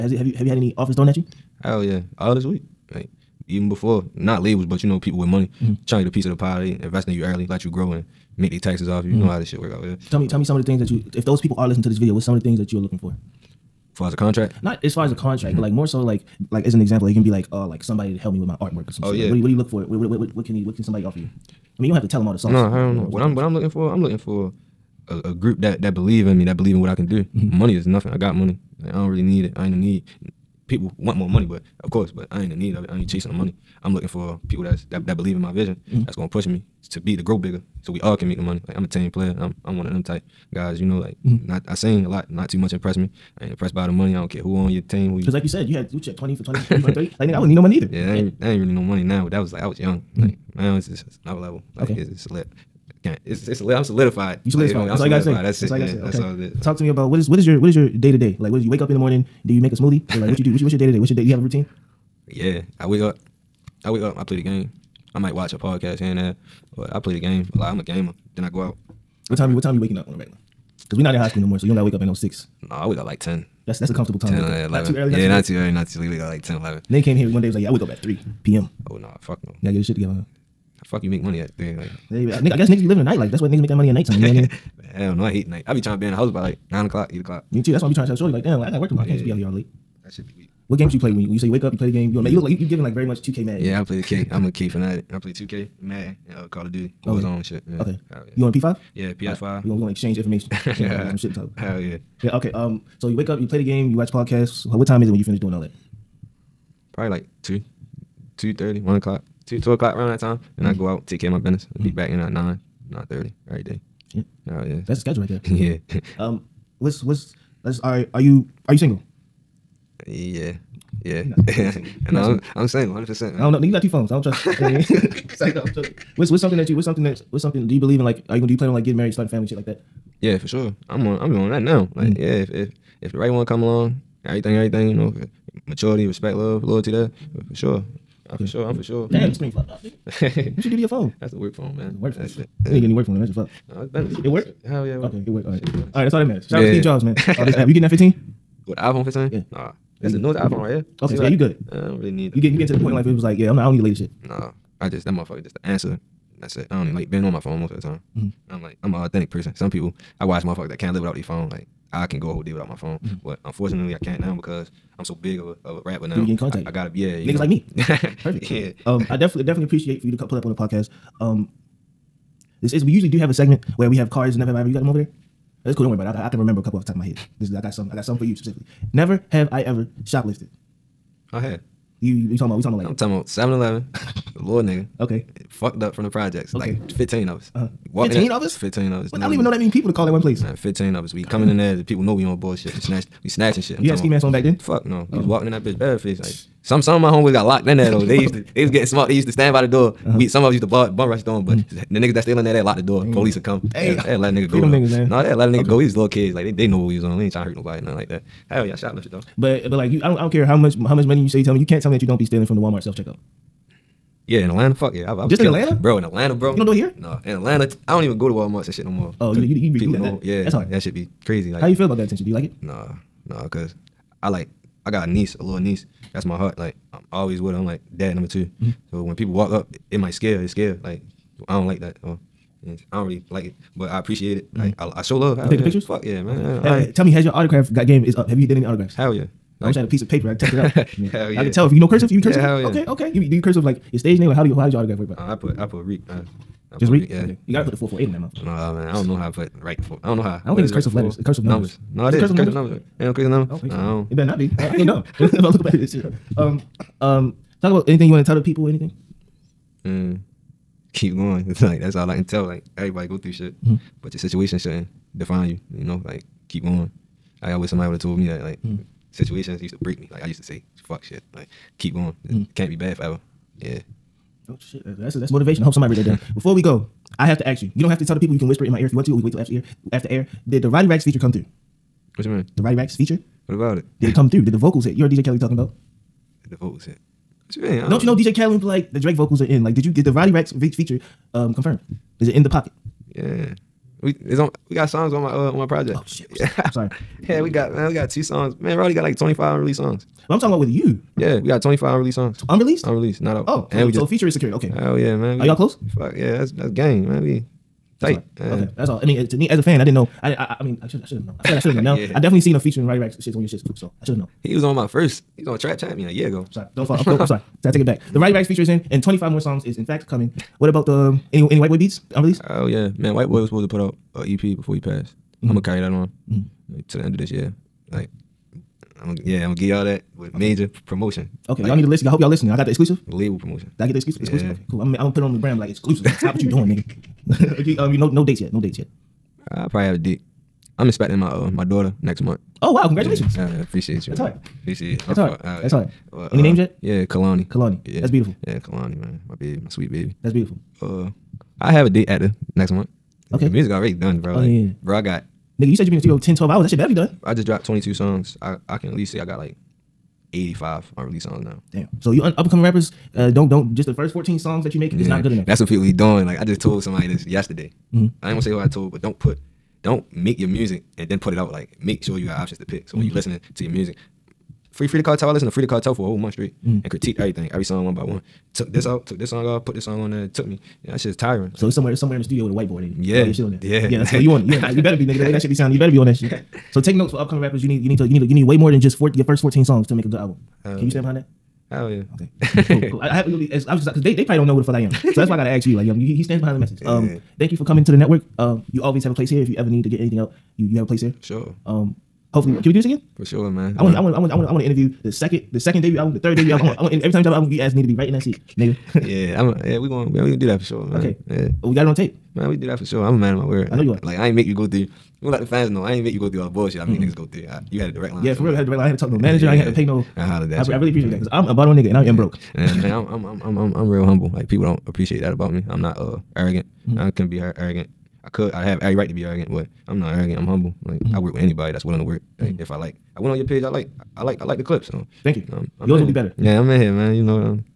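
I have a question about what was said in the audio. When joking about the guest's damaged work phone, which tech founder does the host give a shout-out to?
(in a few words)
Steve Jobs.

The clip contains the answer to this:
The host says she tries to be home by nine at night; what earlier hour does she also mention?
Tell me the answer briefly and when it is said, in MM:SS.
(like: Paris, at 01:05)
8 o'clock, at 01:27.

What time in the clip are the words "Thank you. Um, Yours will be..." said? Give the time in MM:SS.
07:15.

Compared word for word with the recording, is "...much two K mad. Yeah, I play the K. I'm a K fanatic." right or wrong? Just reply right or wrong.
right.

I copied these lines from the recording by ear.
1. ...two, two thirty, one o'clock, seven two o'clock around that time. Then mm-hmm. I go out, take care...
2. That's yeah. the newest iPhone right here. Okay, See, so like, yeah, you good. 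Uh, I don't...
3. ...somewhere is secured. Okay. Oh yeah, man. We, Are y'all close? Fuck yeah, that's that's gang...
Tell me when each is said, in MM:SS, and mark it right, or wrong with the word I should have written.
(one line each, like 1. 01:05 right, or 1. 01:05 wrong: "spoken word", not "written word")
1. 01:47 wrong: "two", not "seven"
2. 02:30 right
3. 05:04 wrong: "feature", not "somewhere".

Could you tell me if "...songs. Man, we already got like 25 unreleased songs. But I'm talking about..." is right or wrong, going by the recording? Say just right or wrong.
right.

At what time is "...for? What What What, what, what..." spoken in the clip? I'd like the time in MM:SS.
00:19.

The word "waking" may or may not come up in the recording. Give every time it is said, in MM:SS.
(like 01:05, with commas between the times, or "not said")
01:09.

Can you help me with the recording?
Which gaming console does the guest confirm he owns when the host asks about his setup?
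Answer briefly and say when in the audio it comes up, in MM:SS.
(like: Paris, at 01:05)
PS5, at 01:39.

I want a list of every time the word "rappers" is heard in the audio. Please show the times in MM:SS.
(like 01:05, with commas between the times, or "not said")
02:45, 06:02, 06:27.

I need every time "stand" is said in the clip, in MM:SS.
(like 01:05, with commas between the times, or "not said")
03:19, 06:30, 06:36.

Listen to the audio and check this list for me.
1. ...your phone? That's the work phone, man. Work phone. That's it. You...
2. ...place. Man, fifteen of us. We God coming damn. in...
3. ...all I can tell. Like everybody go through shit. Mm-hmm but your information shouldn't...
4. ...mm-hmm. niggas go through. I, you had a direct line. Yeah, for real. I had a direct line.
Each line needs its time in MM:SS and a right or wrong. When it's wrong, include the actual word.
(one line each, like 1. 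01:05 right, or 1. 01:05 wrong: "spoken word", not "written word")
1. 02:20 right
2. 03:10 right
3. 04:21 wrong: "situation", not "information"
4. 06:56 right.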